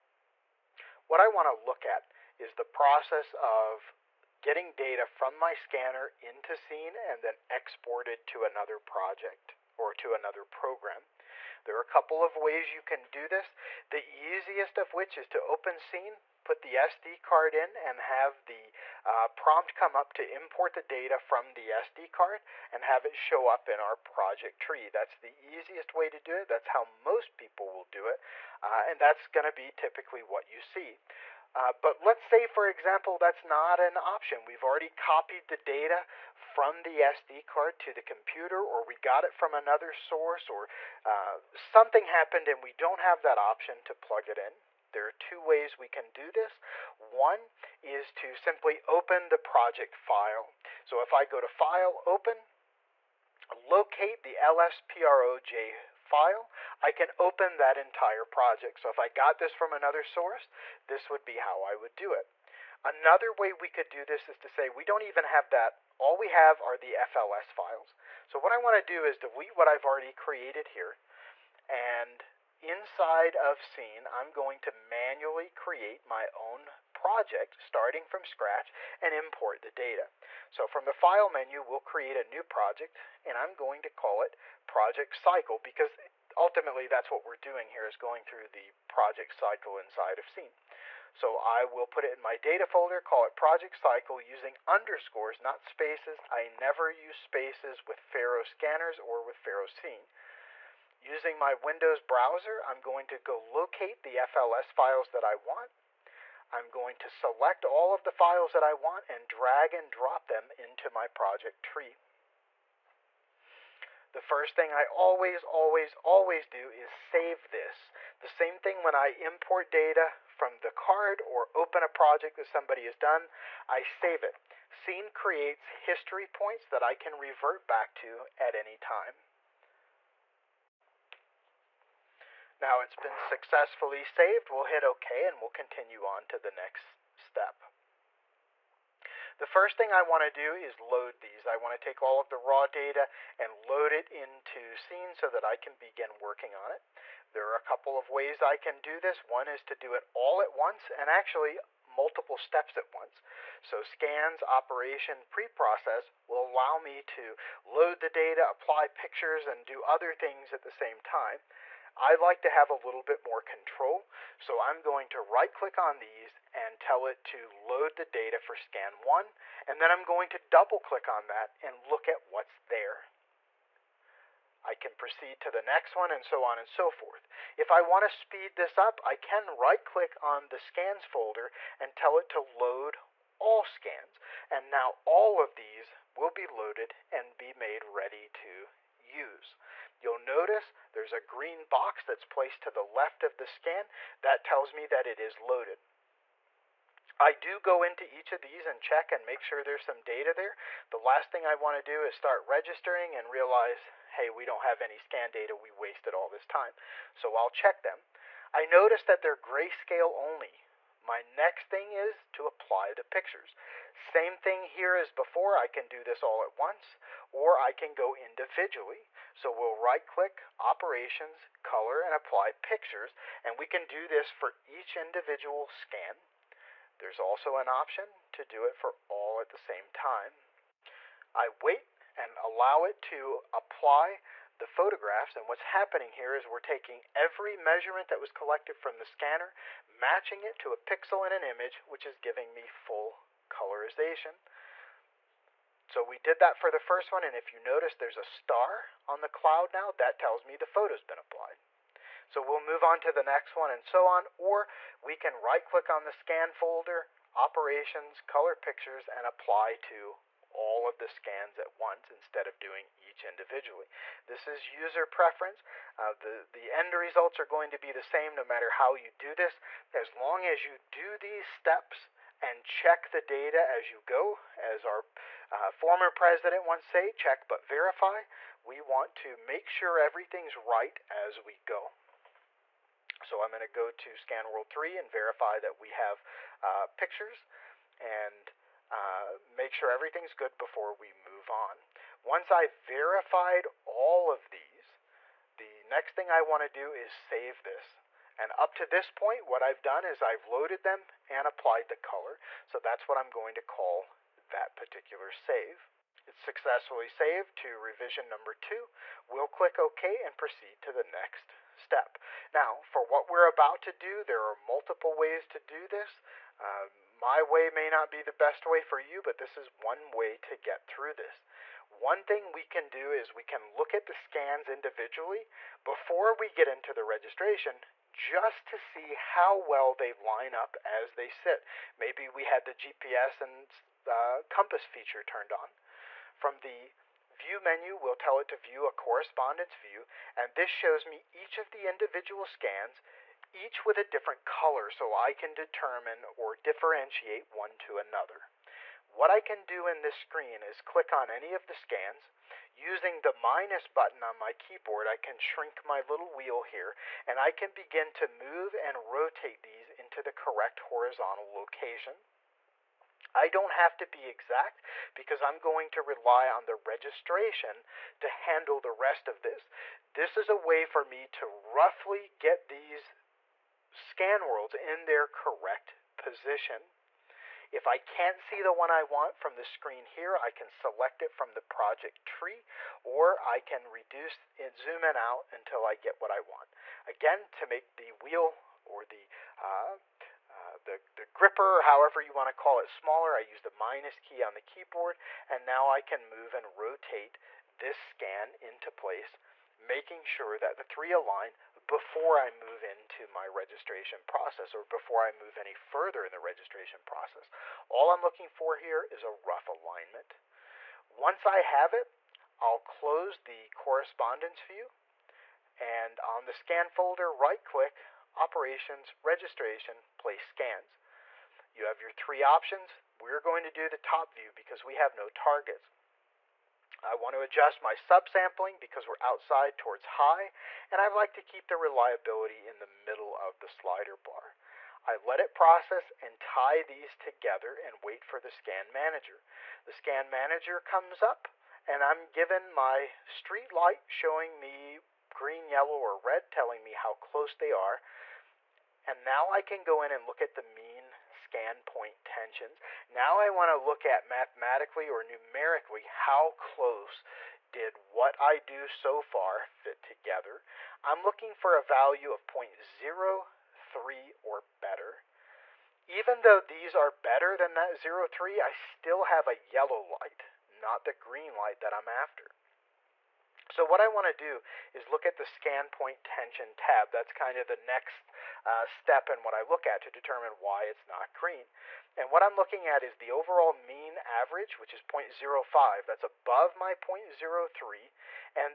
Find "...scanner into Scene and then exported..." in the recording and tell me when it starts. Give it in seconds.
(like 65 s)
5 s.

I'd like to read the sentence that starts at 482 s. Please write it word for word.
And what I'm looking at is the overall mean average, which is 0.05.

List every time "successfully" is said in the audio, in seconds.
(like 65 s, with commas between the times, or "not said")
133 s, 306 s.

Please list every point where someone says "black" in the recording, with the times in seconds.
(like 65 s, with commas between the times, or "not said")
not said.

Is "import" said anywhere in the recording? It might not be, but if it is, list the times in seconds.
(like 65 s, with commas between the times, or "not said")
20 s, 79 s, 119 s.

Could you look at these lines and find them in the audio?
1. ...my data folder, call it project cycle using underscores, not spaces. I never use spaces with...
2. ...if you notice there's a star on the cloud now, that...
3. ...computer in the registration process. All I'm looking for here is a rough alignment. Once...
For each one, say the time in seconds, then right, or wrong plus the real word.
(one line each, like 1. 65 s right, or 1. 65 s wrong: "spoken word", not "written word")
1. 92 s right
2. 247 s right
3. 405 s wrong: "further", not "computer".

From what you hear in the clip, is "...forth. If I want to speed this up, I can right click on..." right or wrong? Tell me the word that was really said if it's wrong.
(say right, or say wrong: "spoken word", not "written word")
right.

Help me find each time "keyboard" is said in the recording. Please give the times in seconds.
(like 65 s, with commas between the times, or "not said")
354 s, 394 s.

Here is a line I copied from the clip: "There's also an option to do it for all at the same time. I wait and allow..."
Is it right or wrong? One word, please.
right.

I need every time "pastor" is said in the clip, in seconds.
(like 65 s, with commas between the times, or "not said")
not said.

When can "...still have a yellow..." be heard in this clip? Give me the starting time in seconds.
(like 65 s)
468 s.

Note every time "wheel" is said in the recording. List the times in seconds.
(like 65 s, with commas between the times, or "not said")
356 s, 388 s.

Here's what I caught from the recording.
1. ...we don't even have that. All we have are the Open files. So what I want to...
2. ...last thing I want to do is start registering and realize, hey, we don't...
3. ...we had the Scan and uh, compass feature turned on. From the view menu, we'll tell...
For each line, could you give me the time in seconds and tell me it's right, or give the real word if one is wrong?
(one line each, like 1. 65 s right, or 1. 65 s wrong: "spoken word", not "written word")
1. 64 s wrong: "FLS", not "Open"
2. 200 s right
3. 332 s wrong: "GPS", not "Scan".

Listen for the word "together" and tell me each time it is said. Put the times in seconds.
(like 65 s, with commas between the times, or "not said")
437 s, 460 s.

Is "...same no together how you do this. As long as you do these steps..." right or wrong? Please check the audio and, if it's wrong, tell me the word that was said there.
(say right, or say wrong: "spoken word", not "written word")
wrong: "matter", not "together".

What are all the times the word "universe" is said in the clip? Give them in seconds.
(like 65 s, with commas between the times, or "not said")
not said.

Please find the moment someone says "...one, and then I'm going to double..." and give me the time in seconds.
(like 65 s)
169 s.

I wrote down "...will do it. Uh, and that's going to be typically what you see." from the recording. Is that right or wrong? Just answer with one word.
right.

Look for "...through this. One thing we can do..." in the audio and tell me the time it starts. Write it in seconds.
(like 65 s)
320 s.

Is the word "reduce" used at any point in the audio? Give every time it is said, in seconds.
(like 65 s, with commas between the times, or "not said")
383 s.